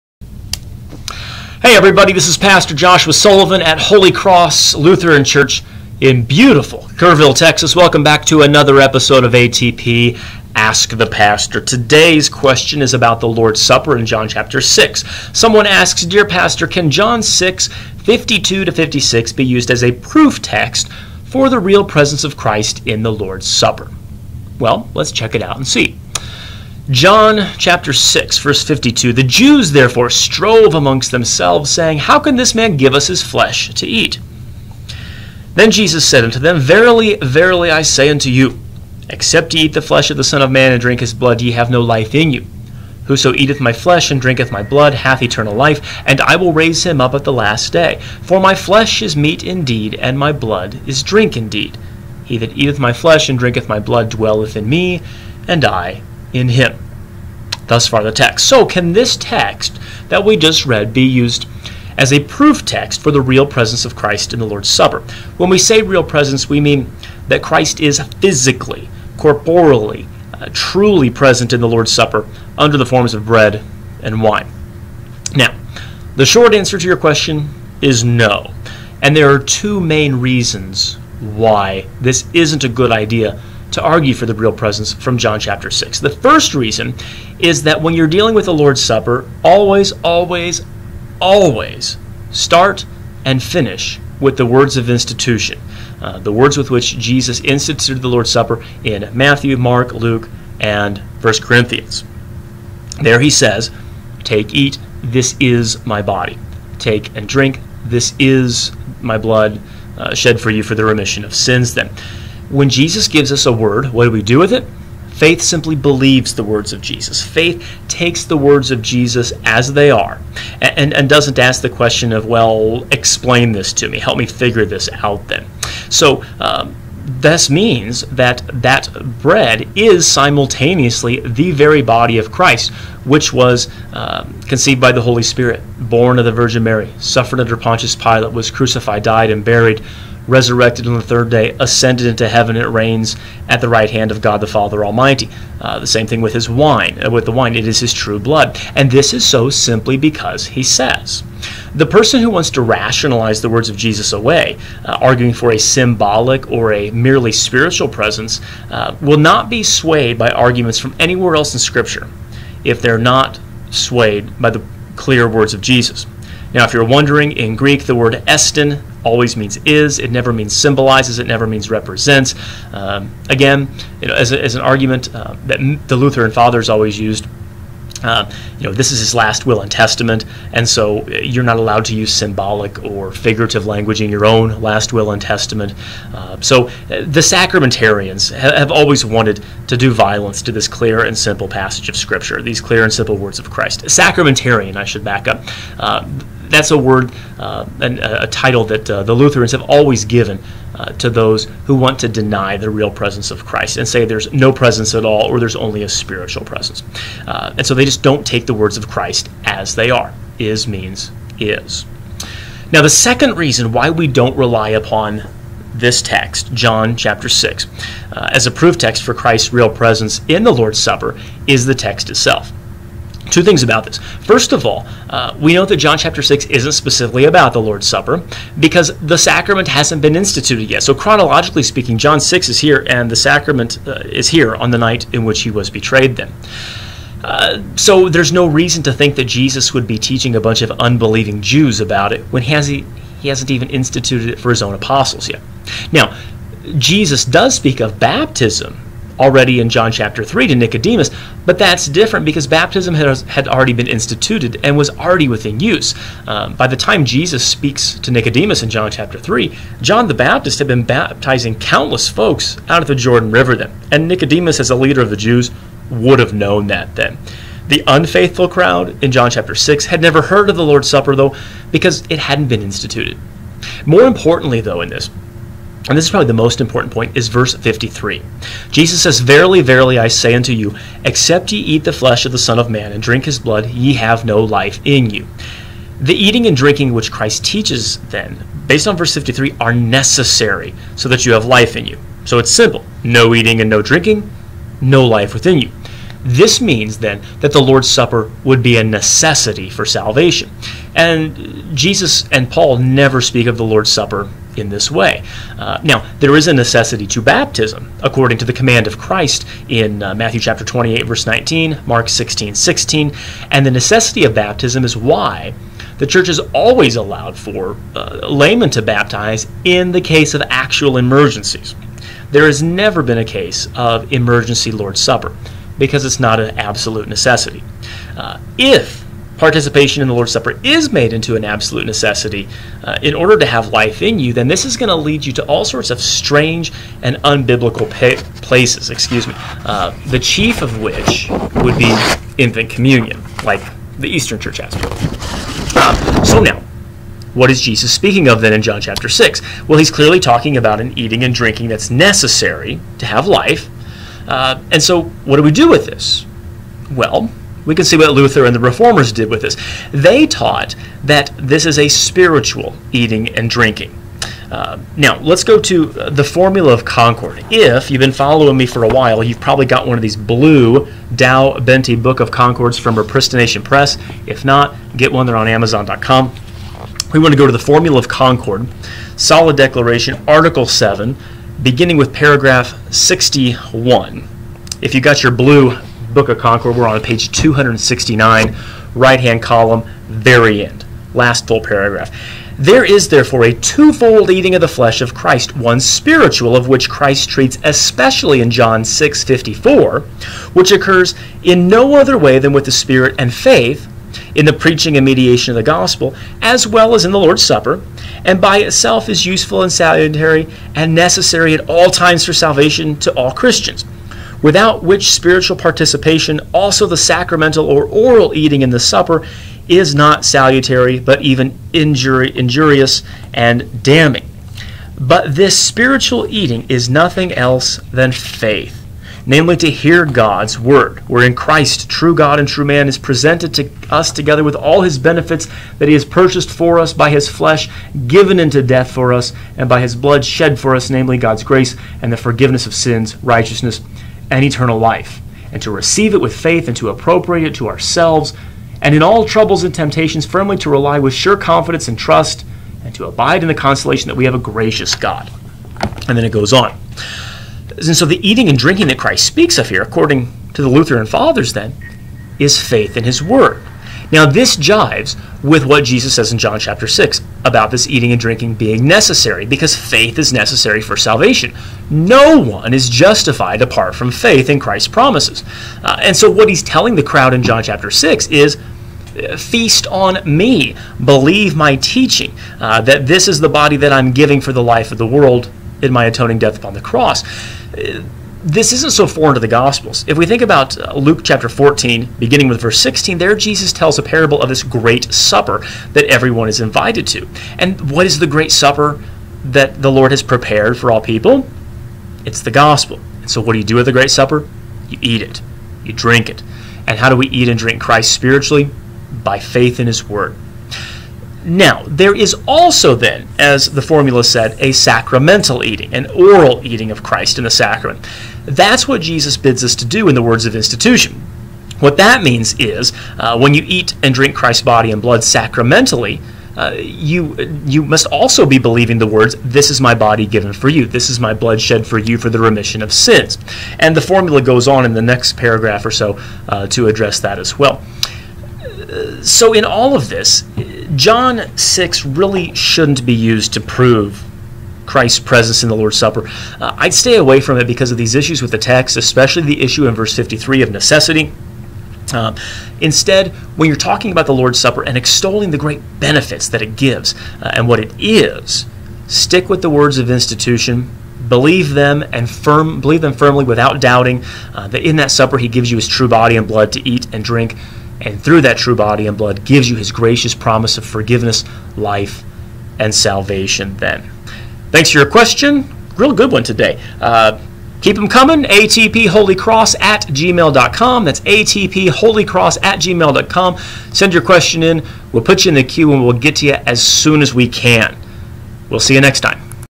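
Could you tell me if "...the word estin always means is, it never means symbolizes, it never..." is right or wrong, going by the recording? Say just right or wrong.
right.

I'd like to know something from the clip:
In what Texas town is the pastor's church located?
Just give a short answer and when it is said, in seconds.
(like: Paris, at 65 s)
Kerrville, at 6 s.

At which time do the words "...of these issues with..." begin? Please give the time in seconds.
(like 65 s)
547 s.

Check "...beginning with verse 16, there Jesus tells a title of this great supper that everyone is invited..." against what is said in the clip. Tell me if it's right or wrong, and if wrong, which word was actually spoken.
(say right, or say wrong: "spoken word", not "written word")
wrong: "parable", not "title".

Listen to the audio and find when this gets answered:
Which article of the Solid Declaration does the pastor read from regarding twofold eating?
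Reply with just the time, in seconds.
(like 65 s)
380 s.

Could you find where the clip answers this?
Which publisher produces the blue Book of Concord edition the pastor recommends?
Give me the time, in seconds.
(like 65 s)
372 s.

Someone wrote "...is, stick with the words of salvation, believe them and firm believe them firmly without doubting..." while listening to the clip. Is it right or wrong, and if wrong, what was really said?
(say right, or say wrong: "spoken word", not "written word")
wrong: "institution", not "salvation".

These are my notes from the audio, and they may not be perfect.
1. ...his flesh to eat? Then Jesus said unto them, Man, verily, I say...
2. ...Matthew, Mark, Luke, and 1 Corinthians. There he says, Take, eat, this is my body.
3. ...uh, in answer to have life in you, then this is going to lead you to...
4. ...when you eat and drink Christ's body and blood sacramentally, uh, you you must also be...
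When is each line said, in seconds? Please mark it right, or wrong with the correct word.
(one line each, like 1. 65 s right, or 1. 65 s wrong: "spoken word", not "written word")
1. 33 s wrong: "Verily", not "Man"
2. 99 s right
3. 332 s wrong: "order", not "answer"
4. 523 s right.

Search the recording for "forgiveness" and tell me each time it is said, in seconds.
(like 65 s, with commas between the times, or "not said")
442 s, 570 s.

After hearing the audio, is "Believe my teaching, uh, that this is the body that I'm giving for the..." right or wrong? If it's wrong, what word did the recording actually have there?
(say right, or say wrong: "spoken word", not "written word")
right.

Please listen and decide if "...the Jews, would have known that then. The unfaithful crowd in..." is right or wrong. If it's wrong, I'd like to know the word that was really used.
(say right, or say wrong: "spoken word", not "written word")
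right.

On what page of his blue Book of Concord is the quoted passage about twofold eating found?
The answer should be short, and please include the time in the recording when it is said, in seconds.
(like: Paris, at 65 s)
269, at 387 s.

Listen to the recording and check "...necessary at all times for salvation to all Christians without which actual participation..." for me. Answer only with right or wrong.
wrong.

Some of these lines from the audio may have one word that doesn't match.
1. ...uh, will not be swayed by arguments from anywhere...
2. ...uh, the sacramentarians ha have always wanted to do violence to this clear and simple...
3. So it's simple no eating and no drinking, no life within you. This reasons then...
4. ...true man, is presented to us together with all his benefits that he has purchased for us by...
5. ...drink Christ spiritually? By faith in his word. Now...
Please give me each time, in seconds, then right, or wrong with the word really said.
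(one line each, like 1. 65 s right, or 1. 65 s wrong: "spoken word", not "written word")
1. 158 s right
2. 186 s right
3. 292 s wrong: "means", not "reasons"
4. 432 s right
5. 507 s right.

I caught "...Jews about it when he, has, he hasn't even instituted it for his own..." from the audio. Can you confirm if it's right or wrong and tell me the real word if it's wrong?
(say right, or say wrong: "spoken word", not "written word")
right.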